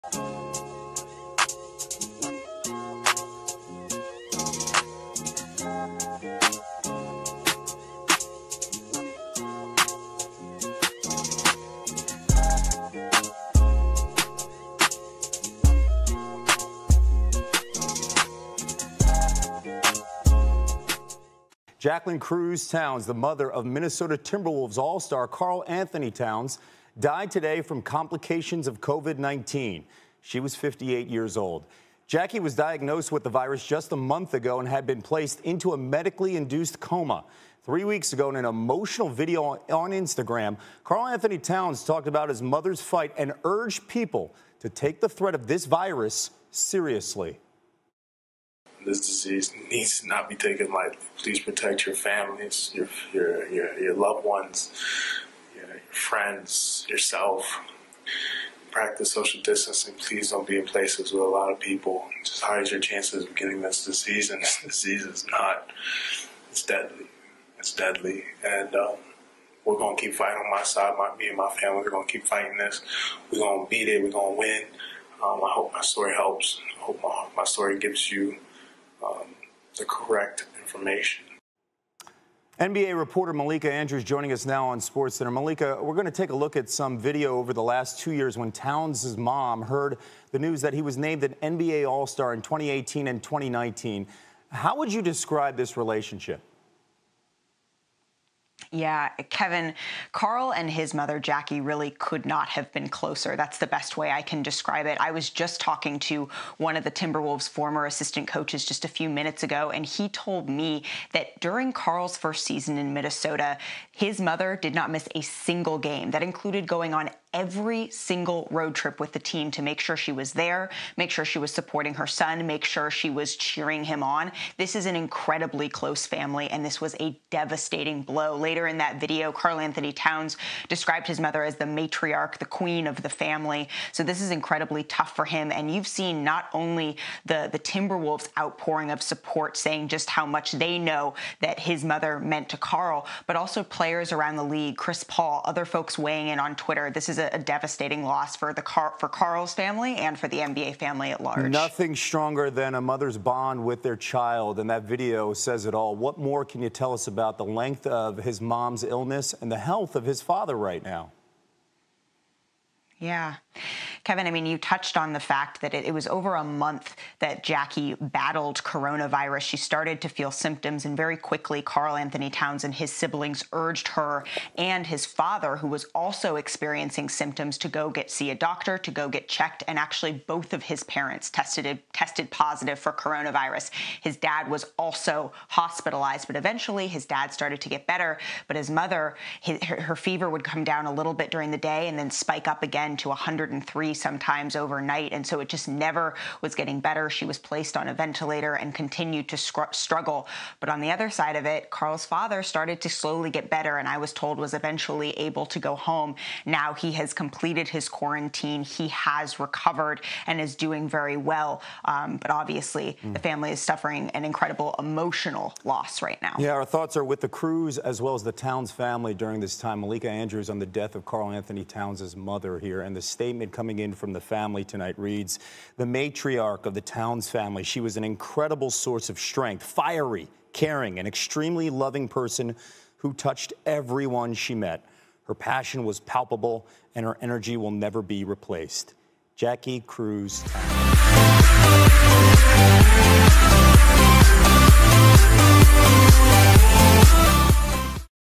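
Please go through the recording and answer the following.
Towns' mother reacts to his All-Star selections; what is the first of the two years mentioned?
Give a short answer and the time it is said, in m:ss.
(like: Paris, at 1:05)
2018, at 1:32.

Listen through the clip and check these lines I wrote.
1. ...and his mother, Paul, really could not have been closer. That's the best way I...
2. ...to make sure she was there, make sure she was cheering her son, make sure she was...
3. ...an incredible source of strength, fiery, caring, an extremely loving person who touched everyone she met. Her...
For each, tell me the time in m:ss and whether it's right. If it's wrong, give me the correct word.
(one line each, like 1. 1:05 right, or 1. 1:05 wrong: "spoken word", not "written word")
1. 1:40 wrong: "Jackie", not "Paul"
2. 1:59 wrong: "supporting", not "cheering"
3. 3:47 right.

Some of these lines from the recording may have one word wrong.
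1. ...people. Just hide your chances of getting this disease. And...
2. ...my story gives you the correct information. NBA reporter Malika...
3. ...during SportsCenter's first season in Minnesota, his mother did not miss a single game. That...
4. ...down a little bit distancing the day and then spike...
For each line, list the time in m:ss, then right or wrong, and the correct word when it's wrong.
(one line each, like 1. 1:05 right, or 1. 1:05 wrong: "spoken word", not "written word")
1. 1:01 right
2. 1:17 right
3. 1:51 wrong: "Karl", not "SportsCenter"
4. 3:10 wrong: "during", not "distancing".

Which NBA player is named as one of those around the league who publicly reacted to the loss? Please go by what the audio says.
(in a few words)
Chris Paul.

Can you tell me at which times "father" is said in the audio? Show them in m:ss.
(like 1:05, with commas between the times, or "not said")
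2:40, 2:55, 3:22.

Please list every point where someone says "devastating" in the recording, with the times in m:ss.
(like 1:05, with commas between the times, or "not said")
2:07, 2:27.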